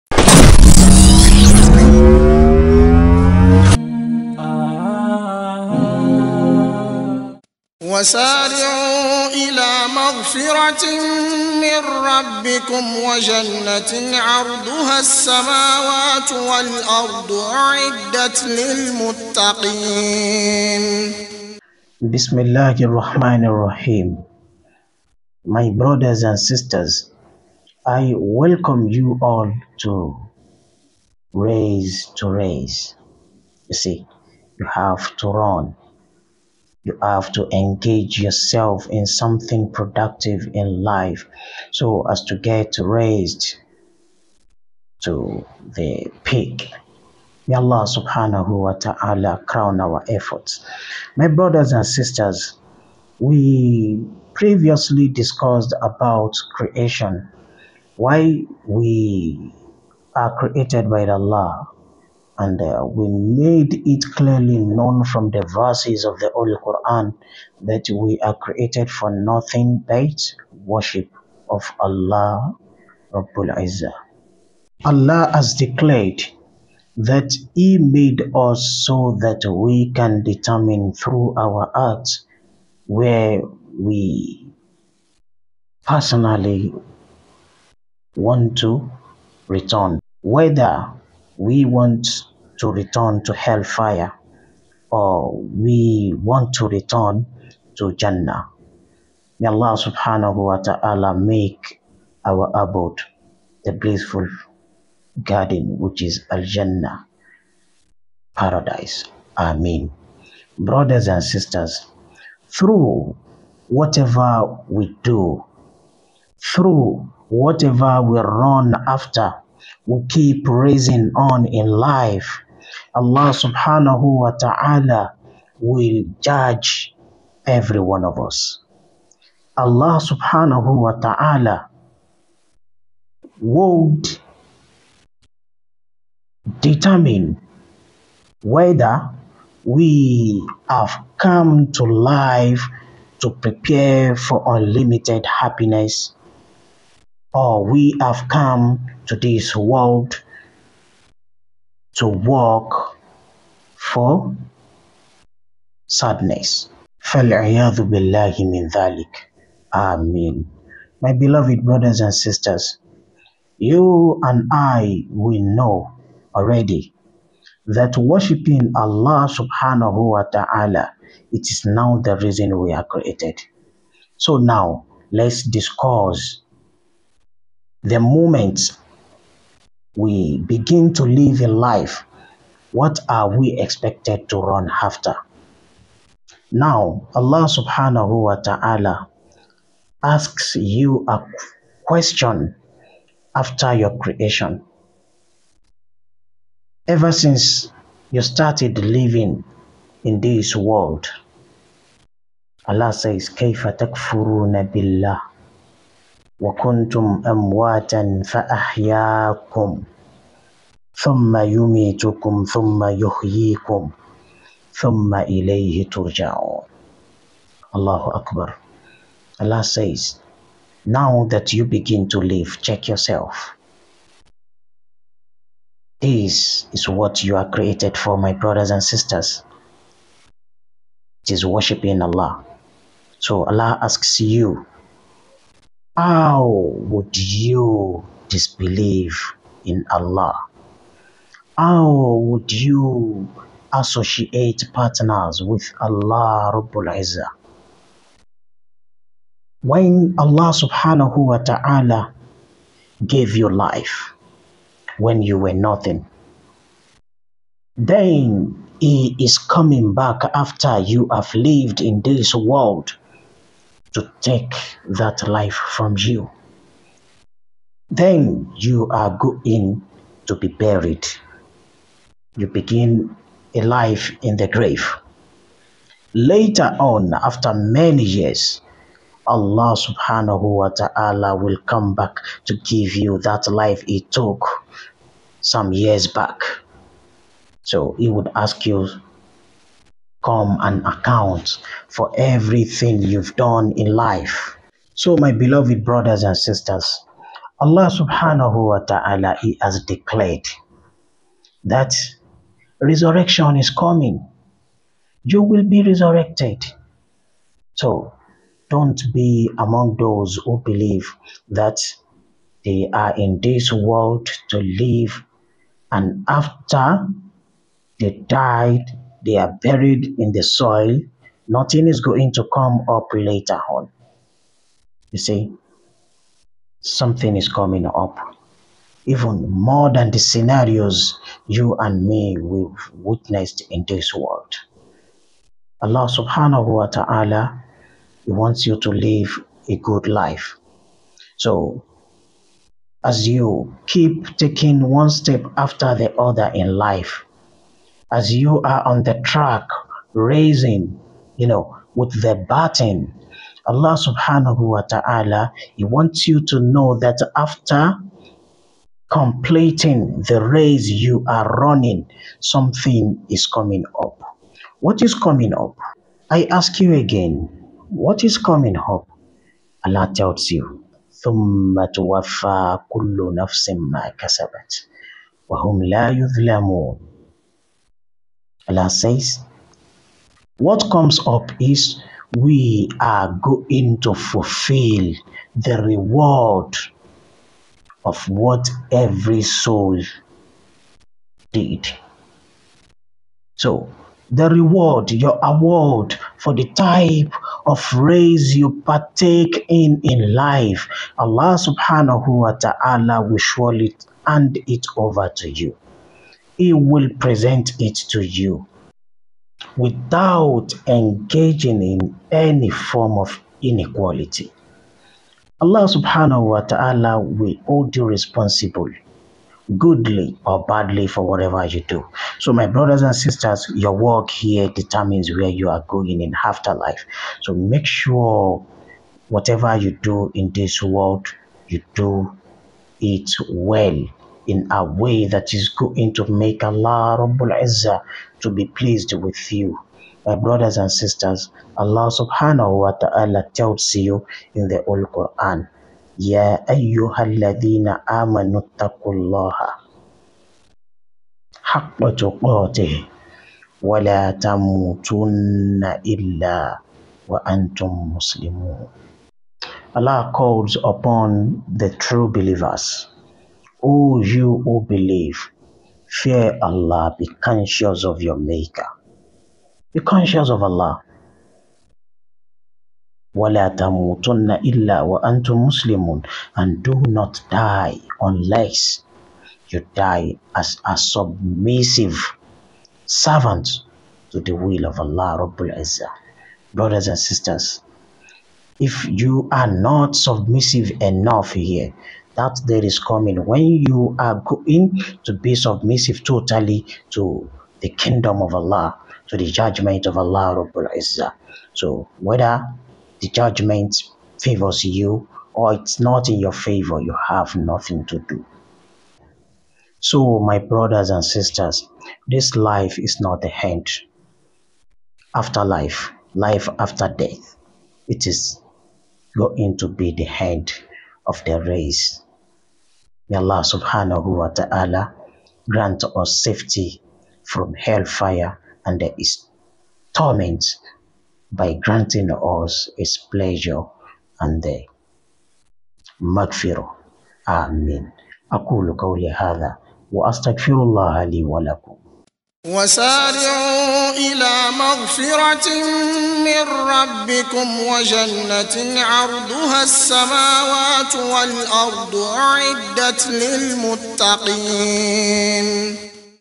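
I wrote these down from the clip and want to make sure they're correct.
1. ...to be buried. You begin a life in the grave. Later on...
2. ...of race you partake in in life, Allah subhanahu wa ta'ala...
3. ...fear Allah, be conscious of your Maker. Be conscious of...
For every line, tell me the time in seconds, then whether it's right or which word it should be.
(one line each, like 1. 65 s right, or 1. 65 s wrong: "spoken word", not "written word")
1. 270 s right
2. 397 s right
3. 466 s right.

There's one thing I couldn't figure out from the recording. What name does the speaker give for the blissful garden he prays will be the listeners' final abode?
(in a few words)
Al Jannah.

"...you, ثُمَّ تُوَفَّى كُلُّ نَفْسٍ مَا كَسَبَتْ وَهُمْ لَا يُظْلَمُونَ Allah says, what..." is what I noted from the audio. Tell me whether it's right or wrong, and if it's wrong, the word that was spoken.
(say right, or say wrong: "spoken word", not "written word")
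right.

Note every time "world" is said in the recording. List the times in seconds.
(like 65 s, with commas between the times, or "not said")
149 s, 200 s, 262 s, 313 s, 334 s, 430 s.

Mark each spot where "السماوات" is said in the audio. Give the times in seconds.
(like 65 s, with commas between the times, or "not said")
14 s, 549 s.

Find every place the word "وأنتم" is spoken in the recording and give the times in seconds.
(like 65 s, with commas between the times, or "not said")
475 s.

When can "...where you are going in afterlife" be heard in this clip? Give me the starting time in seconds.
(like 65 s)
425 s.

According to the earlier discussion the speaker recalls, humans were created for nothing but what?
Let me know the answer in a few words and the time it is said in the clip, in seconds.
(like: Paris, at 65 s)
worship of Allah, at 70 s.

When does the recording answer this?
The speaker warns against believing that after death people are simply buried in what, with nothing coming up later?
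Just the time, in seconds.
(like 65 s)
320 s.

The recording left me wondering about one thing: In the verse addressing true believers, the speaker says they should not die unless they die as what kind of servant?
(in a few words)
submissive servant.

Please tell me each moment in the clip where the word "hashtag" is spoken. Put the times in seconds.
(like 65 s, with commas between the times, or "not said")
not said.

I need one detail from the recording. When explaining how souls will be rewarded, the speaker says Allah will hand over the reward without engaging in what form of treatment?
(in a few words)
inequality.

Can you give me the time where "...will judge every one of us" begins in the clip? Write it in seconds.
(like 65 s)
125 s.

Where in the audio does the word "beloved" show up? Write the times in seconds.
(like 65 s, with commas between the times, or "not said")
161 s, 295 s.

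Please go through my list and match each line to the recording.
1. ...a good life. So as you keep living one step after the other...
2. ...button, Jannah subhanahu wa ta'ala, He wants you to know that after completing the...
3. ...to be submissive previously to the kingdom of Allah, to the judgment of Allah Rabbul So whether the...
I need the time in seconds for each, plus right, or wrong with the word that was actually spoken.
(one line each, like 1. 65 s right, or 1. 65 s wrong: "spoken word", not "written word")
1. 339 s wrong: "taking", not "living"
2. 352 s wrong: "Allah", not "Jannah"
3. 495 s wrong: "totally", not "previously".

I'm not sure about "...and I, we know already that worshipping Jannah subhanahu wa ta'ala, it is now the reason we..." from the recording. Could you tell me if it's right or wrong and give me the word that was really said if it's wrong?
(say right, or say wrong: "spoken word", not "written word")
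wrong: "Allah", not "Jannah".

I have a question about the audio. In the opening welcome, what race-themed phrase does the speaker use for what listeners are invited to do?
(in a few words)
raise to raise.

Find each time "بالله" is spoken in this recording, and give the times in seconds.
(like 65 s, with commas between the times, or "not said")
157 s, 204 s.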